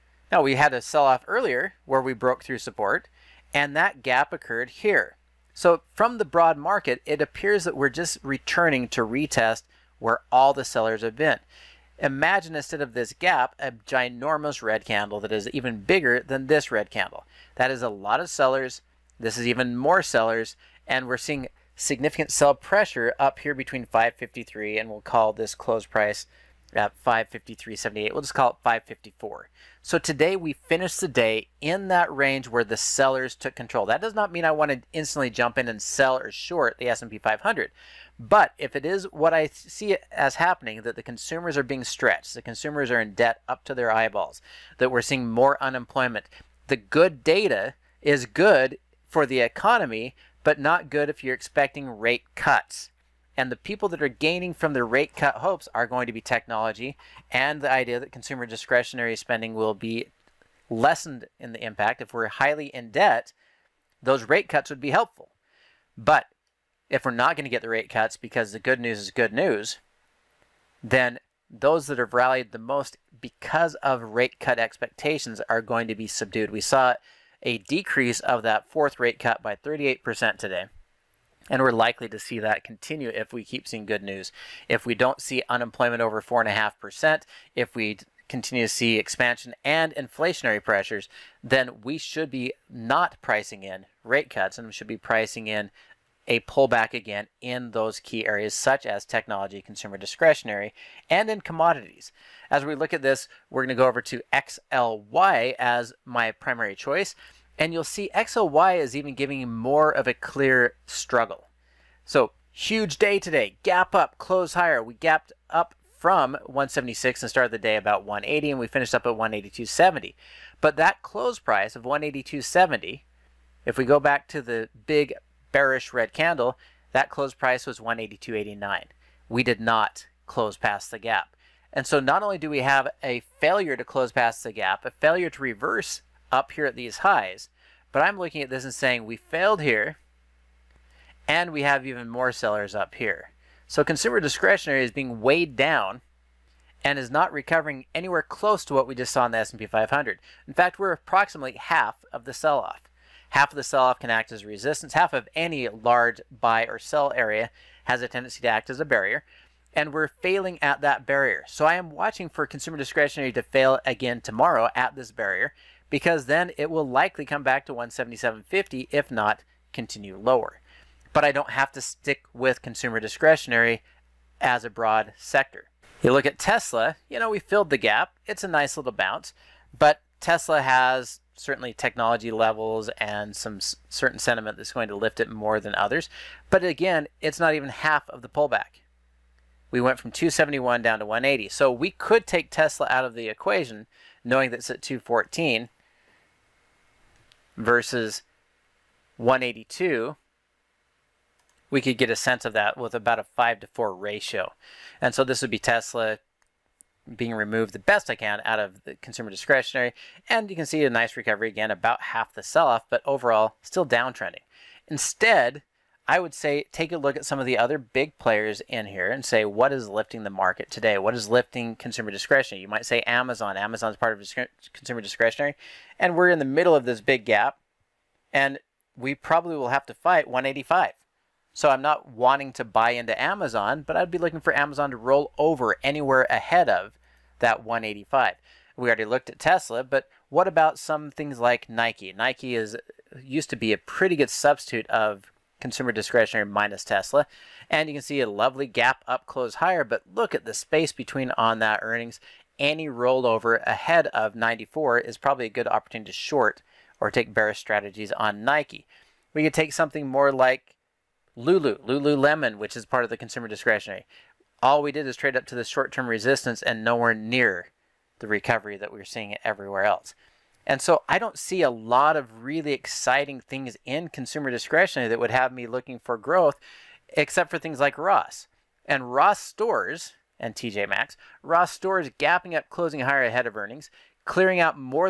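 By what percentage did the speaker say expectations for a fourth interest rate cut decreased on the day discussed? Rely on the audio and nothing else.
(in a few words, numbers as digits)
38%.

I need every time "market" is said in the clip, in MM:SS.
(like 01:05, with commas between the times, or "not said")
00:06, 03:40.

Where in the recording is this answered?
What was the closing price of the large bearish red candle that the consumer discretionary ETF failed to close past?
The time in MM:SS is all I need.
02:07.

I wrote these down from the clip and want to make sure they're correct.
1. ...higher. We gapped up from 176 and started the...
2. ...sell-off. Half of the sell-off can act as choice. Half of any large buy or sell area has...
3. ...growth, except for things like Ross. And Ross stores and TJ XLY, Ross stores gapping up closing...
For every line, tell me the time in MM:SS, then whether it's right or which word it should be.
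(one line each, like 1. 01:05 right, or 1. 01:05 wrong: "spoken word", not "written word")
1. 01:54 right
2. 02:32 wrong: "resistance", not "choice"
3. 04:36 wrong: "Maxx", not "XLY".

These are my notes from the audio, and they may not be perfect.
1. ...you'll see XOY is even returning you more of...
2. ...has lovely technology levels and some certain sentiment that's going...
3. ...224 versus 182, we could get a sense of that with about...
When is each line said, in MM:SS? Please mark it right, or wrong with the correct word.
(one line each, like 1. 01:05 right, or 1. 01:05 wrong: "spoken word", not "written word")
1. 01:47 wrong: "giving", not "returning"
2. 03:00 wrong: "certainly", not "lovely"
3. 03:14 wrong: "214", not "224".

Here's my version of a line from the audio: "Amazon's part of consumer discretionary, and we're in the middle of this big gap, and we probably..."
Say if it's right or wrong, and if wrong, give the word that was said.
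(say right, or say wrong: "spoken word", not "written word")
right.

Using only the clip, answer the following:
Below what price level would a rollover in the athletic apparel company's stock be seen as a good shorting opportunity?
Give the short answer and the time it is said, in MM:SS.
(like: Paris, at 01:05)
94, at 04:14.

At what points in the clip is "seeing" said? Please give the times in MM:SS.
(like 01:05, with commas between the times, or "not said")
00:21, 00:45, 01:23, 04:29.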